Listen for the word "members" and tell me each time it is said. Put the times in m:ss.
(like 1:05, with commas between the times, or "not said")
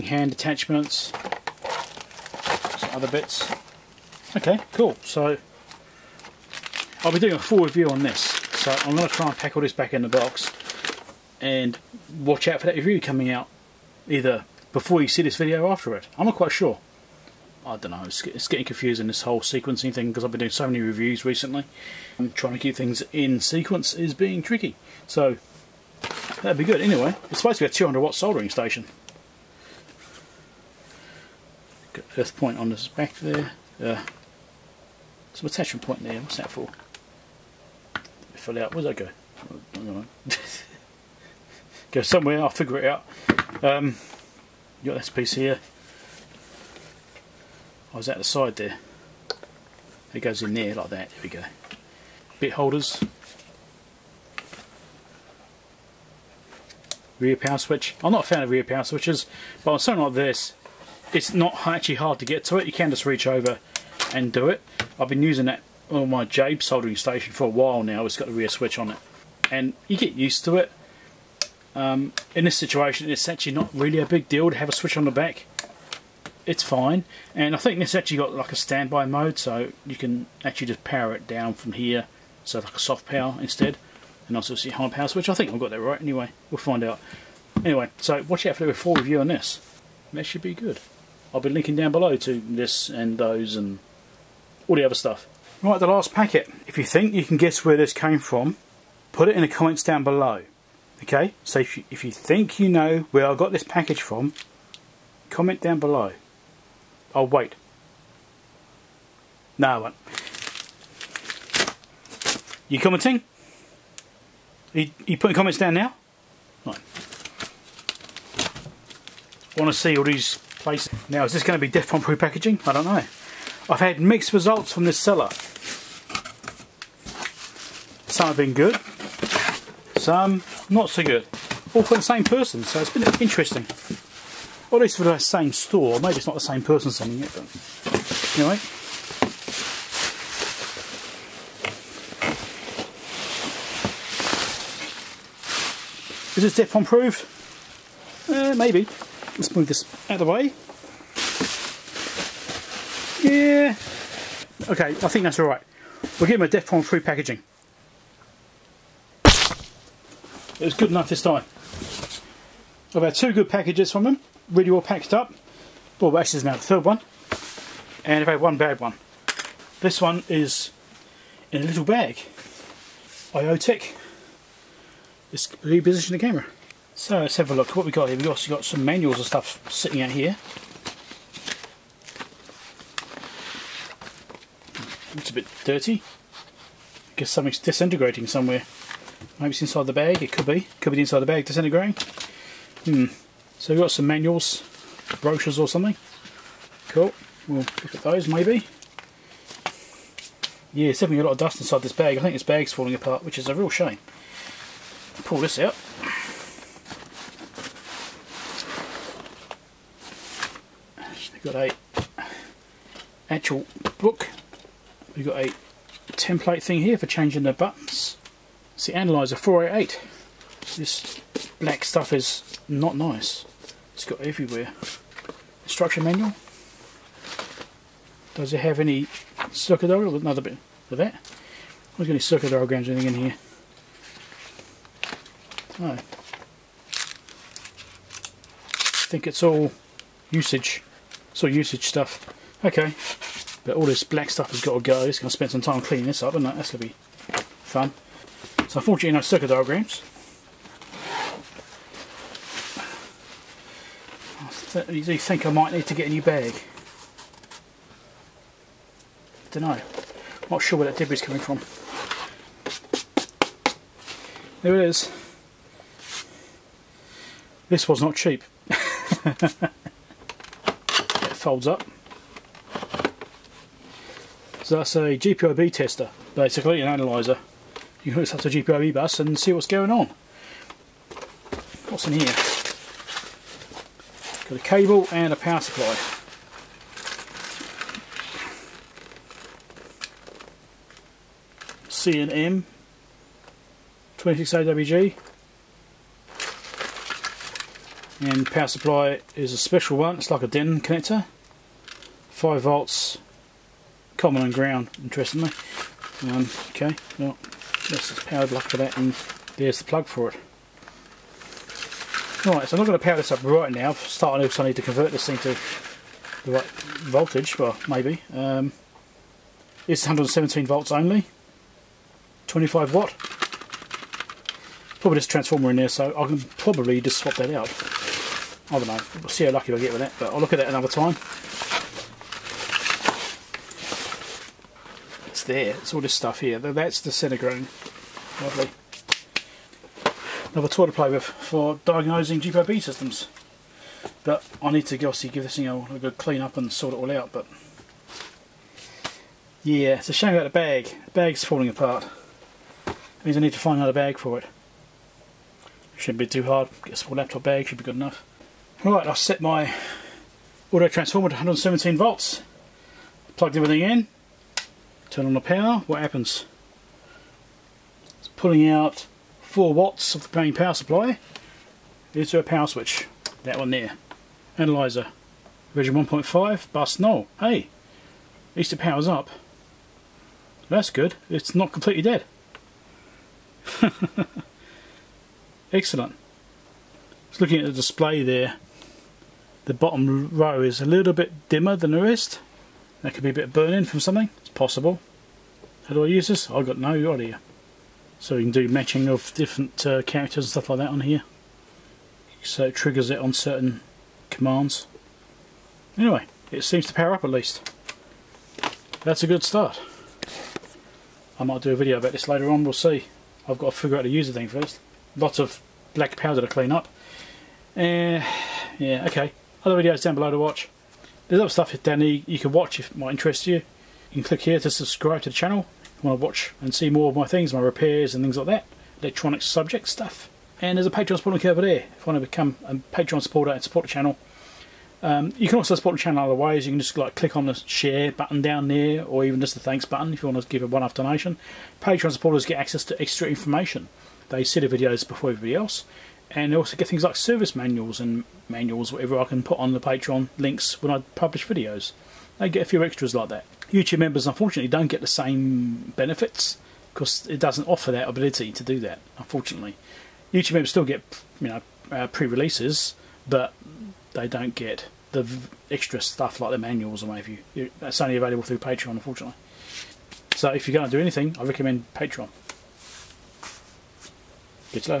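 7:33, 7:40.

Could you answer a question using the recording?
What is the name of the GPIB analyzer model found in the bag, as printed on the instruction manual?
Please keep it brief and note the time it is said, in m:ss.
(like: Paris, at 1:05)
Analyzer 488, at 3:38.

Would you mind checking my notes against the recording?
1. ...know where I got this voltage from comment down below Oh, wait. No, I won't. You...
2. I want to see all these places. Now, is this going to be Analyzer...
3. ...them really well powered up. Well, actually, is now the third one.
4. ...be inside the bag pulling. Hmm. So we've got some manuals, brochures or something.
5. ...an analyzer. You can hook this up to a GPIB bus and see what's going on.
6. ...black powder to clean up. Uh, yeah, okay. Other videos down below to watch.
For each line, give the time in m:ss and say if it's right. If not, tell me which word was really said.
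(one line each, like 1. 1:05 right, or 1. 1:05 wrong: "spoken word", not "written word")
1. 1:42 wrong: "package", not "voltage"
2. 1:59 wrong: "Defcon", not "Analyzer"
3. 2:44 wrong: "packed", not "powered"
4. 3:10 wrong: "disintegrating", not "pulling"
5. 4:36 right
6. 6:55 right.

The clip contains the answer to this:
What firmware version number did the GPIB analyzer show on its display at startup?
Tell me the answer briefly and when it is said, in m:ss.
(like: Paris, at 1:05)
1.5, at 6:15.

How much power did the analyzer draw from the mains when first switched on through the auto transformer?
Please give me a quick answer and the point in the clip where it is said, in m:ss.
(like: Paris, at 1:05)
4 watts, at 6:09.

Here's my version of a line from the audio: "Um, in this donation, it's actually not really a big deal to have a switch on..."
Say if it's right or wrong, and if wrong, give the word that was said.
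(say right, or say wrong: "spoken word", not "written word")
wrong: "situation", not "donation".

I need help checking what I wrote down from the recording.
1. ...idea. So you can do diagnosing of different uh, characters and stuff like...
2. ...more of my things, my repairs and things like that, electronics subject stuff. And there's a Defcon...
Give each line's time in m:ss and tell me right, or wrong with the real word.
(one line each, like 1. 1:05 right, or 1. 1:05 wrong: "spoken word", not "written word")
1. 6:37 wrong: "matching", not "diagnosing"
2. 7:06 wrong: "Patreon", not "Defcon".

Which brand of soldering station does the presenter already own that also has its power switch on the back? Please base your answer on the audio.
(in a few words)
JBC.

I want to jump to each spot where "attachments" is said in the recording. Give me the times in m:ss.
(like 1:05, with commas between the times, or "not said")
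0:00, 0:35.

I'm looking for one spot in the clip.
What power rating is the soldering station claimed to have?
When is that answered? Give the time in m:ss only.
0:27.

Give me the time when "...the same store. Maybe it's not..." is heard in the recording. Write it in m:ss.
2:15.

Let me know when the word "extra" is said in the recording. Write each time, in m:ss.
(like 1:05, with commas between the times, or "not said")
7:23, 7:32, 7:45.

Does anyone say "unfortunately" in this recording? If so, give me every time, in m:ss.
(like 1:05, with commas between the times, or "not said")
4:08, 7:34, 7:39, 7:48.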